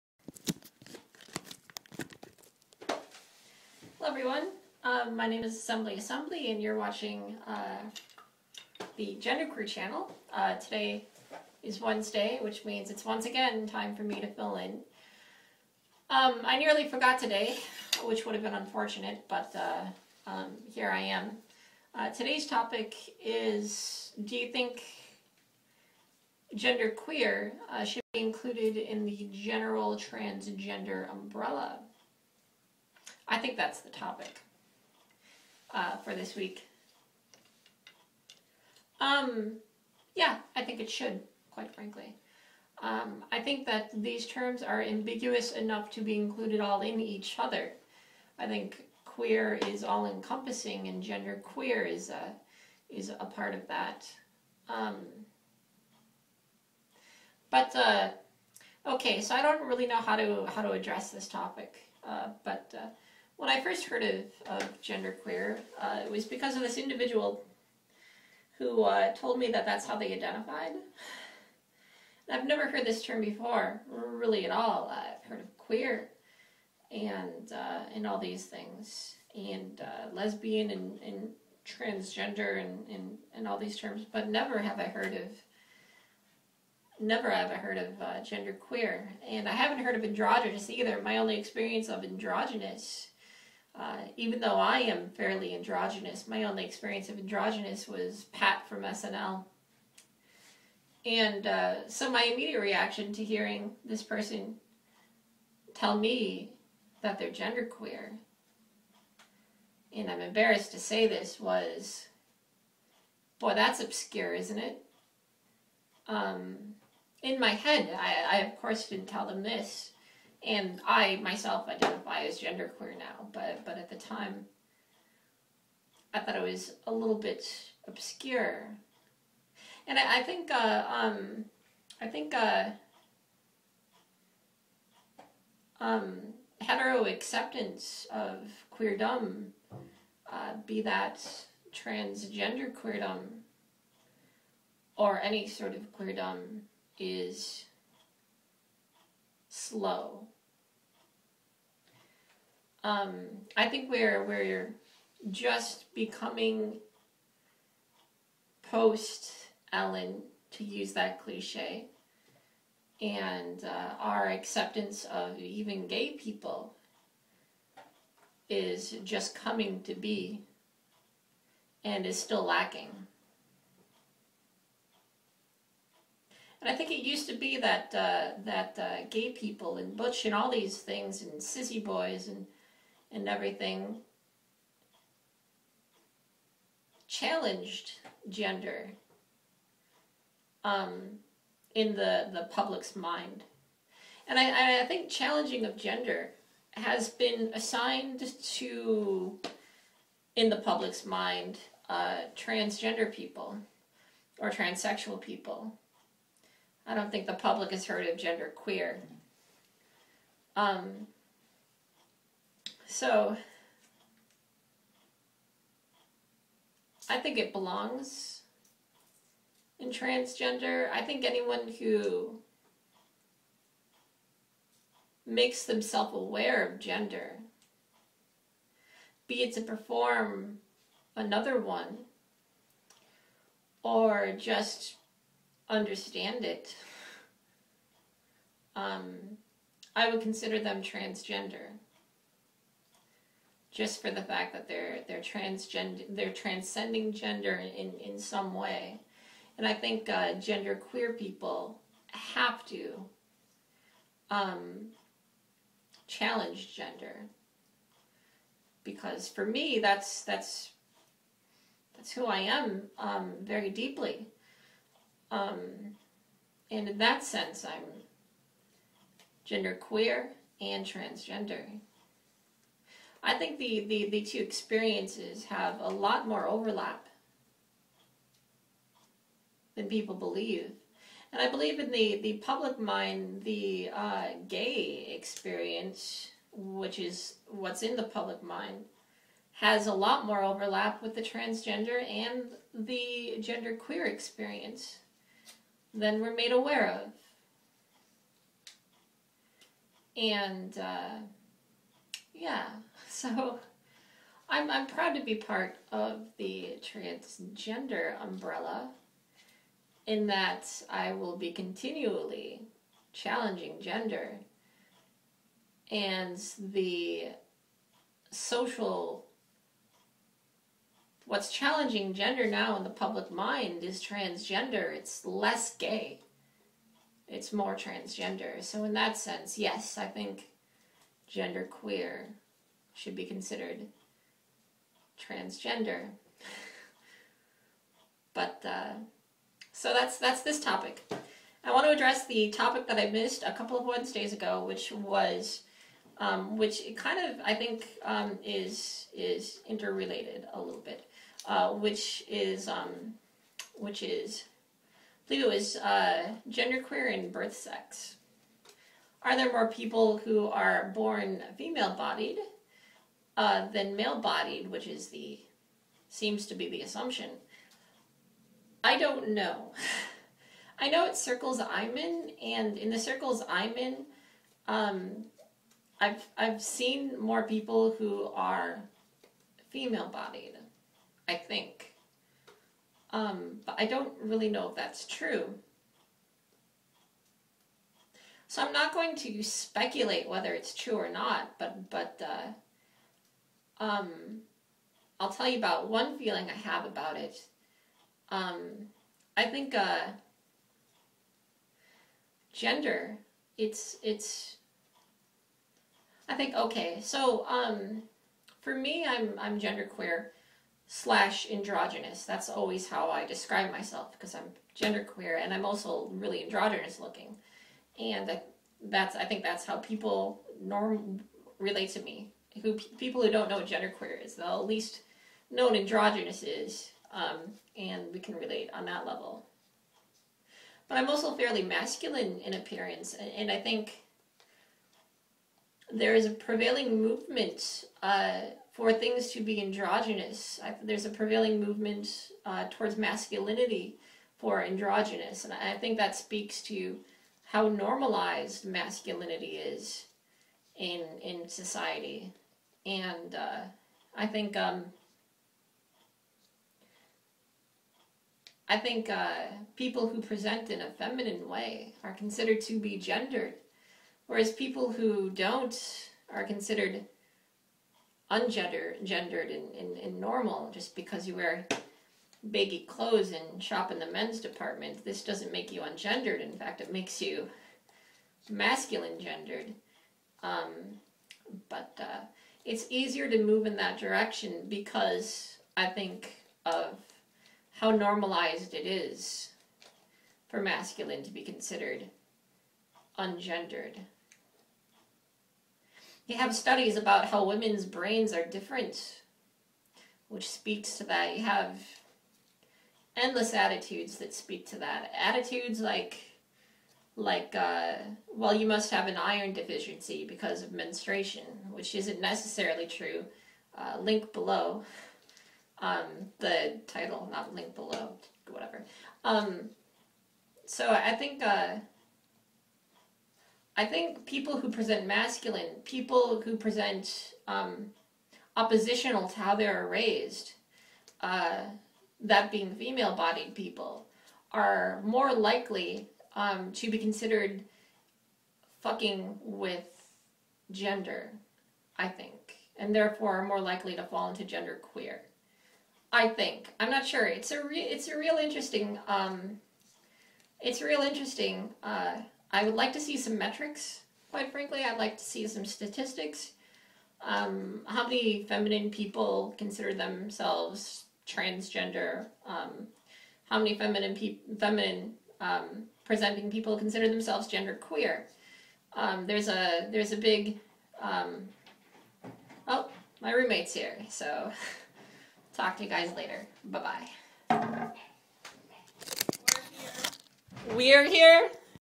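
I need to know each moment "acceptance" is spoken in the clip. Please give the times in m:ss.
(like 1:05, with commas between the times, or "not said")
2:17, 2:44.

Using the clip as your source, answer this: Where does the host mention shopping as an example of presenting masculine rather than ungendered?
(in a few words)
men's department.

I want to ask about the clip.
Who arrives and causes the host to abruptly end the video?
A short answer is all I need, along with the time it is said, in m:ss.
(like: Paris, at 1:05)
roommate, at 9:33.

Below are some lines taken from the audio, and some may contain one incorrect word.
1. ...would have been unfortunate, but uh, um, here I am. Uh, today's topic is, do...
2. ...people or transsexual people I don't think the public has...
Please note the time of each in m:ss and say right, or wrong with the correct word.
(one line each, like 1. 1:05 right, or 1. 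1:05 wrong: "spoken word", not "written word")
1. 0:18 right
2. 3:23 right.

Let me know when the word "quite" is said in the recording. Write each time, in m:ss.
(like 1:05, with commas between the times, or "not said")
0:41, 9:14.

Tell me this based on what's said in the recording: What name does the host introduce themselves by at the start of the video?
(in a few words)
Assembly Assembly.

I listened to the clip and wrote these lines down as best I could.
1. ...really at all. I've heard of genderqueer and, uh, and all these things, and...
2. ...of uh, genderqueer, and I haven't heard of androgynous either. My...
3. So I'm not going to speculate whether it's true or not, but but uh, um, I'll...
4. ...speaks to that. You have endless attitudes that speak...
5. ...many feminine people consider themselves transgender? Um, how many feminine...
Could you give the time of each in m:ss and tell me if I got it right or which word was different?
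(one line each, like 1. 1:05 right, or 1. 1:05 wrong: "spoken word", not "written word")
1. 1:13 wrong: "queer", not "genderqueer"
2. 1:27 right
3. 6:28 right
4. 8:20 right
5. 9:18 right.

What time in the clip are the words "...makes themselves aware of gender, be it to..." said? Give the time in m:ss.
3:45.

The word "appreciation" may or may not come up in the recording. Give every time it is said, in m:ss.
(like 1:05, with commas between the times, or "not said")
not said.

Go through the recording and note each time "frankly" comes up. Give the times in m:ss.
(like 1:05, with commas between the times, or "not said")
0:41, 9:14.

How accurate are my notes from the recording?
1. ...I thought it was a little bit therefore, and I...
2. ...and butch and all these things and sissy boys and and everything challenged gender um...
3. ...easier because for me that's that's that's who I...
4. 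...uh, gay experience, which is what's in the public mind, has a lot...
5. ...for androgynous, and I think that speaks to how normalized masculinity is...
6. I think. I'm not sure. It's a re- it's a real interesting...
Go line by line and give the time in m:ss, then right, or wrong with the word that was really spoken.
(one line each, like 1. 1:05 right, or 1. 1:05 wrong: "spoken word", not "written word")
1. 2:06 wrong: "obscure", not "therefore"
2. 2:59 right
3. 4:16 wrong: "gender", not "easier"
4. 4:43 right
5. 7:24 right
6. 9:06 right.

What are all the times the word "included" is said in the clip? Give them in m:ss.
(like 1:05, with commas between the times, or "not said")
0:28, 0:46.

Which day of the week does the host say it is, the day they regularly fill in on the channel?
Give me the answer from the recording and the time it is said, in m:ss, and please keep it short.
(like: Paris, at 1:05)
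Wednesday, at 0:11.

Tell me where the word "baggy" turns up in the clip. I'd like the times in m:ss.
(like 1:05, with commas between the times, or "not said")
7:52.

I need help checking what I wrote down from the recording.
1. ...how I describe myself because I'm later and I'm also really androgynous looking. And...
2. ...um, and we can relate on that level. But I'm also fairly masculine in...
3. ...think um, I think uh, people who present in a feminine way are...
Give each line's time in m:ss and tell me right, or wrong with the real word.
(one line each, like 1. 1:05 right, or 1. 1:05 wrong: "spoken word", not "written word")
1. 6:52 wrong: "genderqueer", not "later"
2. 7:07 right
3. 7:34 right.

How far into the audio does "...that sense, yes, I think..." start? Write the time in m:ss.
5:28.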